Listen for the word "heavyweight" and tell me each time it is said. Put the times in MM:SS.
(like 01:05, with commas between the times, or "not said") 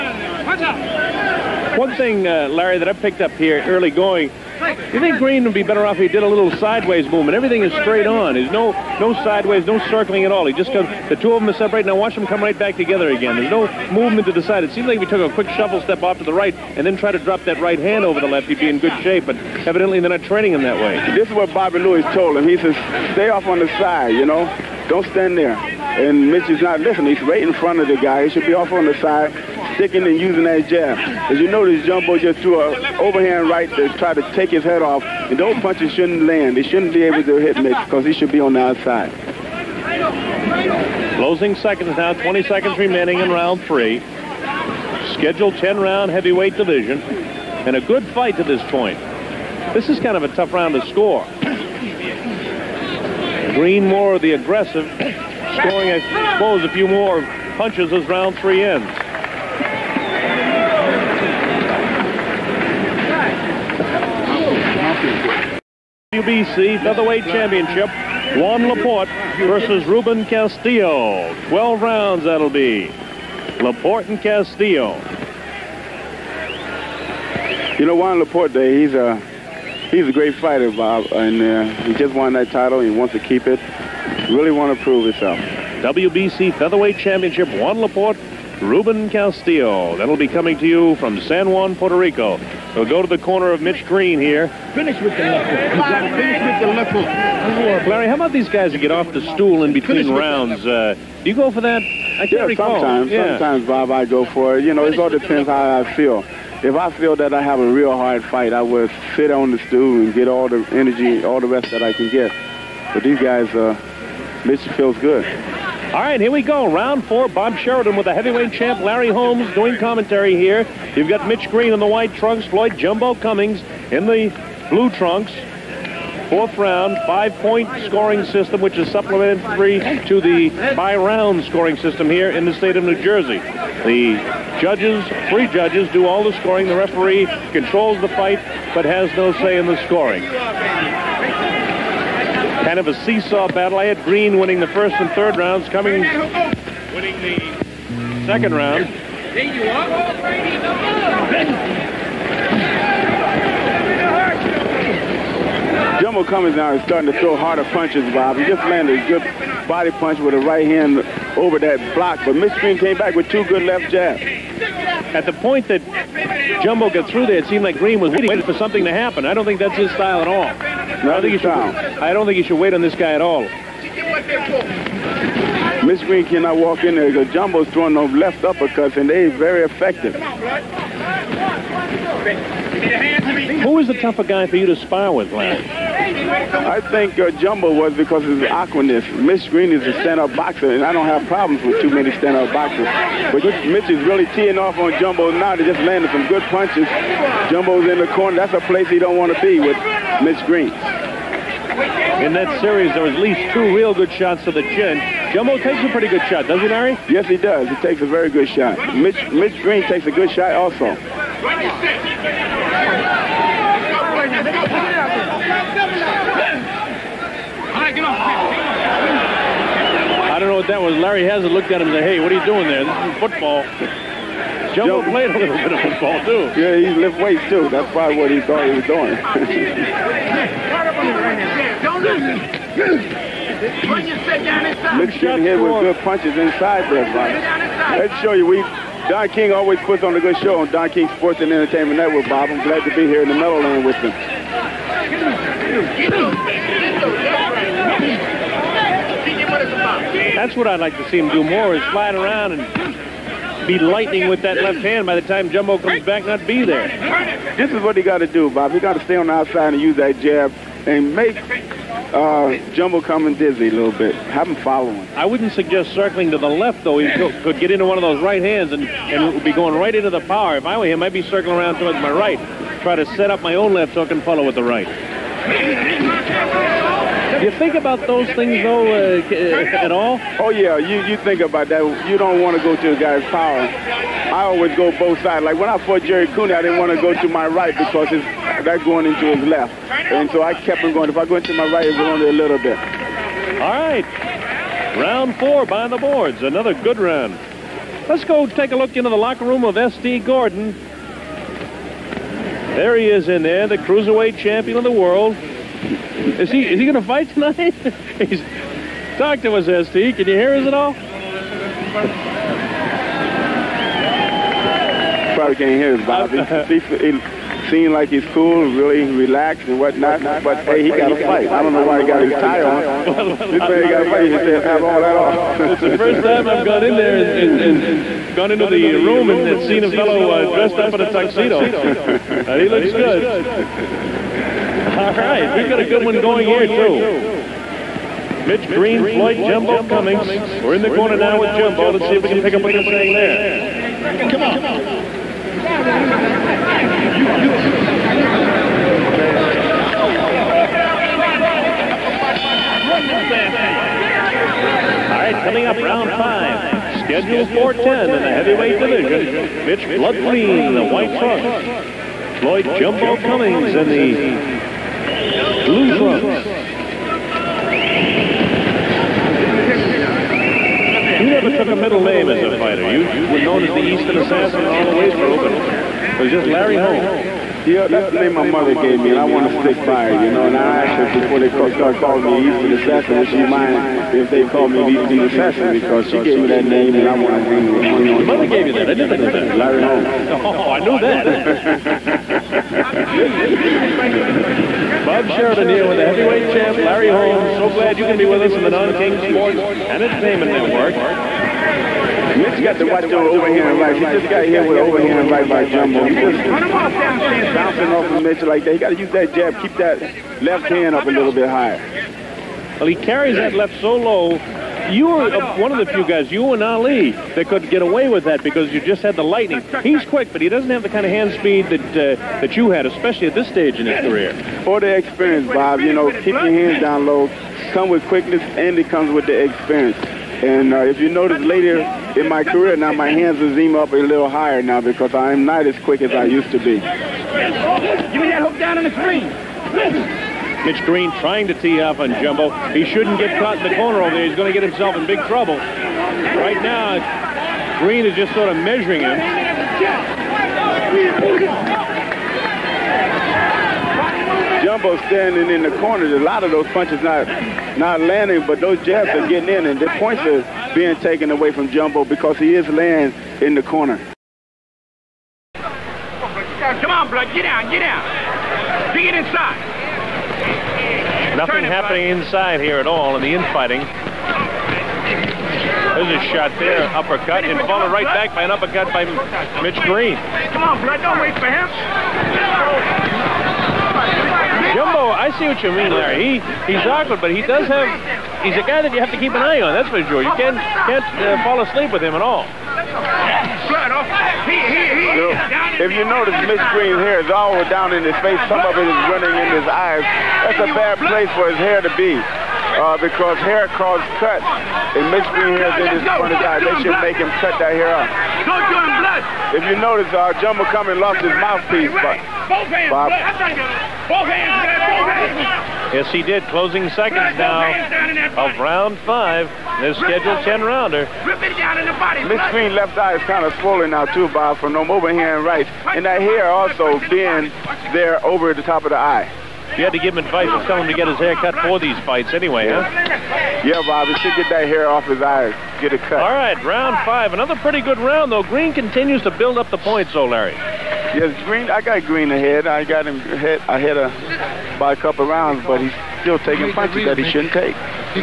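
00:46, 01:58, 05:58, 06:36.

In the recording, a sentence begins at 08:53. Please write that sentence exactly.
Yeah, Bob, he should get that hair off his eyes, get it cut.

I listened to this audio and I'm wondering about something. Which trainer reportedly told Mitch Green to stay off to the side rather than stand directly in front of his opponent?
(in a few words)
Bobby Lewis.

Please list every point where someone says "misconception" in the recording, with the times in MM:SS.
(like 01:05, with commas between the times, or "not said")
not said.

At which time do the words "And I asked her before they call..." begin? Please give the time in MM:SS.
06:20.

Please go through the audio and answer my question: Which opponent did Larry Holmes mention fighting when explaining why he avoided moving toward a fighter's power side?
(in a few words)
Jerry Cooney.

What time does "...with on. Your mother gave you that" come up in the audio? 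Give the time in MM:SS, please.
06:27.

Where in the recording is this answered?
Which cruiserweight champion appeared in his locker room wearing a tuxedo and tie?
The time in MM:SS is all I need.
04:59.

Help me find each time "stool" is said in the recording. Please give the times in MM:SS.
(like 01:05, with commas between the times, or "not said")
01:39, 01:49.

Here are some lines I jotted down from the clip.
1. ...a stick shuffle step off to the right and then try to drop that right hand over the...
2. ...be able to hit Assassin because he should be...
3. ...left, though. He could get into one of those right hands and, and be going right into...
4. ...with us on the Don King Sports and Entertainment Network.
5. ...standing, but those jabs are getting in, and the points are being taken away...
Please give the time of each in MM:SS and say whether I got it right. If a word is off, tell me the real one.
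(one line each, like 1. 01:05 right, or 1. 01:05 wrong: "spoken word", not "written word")
1. 00:15 wrong: "quick", not "stick"
2. 00:36 wrong: "Mitch", not "Assassin"
3. 04:26 right
4. 06:38 right
5. 07:37 wrong: "landing", not "standing".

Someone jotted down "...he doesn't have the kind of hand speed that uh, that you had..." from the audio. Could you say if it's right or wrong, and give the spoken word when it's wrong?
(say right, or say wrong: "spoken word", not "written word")
right.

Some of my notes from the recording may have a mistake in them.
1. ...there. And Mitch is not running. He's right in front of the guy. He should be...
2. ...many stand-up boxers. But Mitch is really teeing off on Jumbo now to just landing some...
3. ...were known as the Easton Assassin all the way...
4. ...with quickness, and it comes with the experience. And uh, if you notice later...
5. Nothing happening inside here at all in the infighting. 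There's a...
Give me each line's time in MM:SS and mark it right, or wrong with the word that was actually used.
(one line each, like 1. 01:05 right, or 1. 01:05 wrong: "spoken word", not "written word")
1. 00:25 wrong: "listening", not "running"
2. 03:11 right
3. 06:13 right
4. 07:07 right
5. 07:51 right.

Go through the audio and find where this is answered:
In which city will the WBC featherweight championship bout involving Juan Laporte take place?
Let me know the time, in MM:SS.
01:31.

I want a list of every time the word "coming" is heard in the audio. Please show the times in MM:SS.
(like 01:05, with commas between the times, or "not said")
01:30, 05:55.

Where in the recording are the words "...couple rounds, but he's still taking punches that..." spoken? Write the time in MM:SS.
09:04.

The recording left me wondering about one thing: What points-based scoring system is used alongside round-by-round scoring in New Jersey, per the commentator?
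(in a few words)
Five-point scoring system.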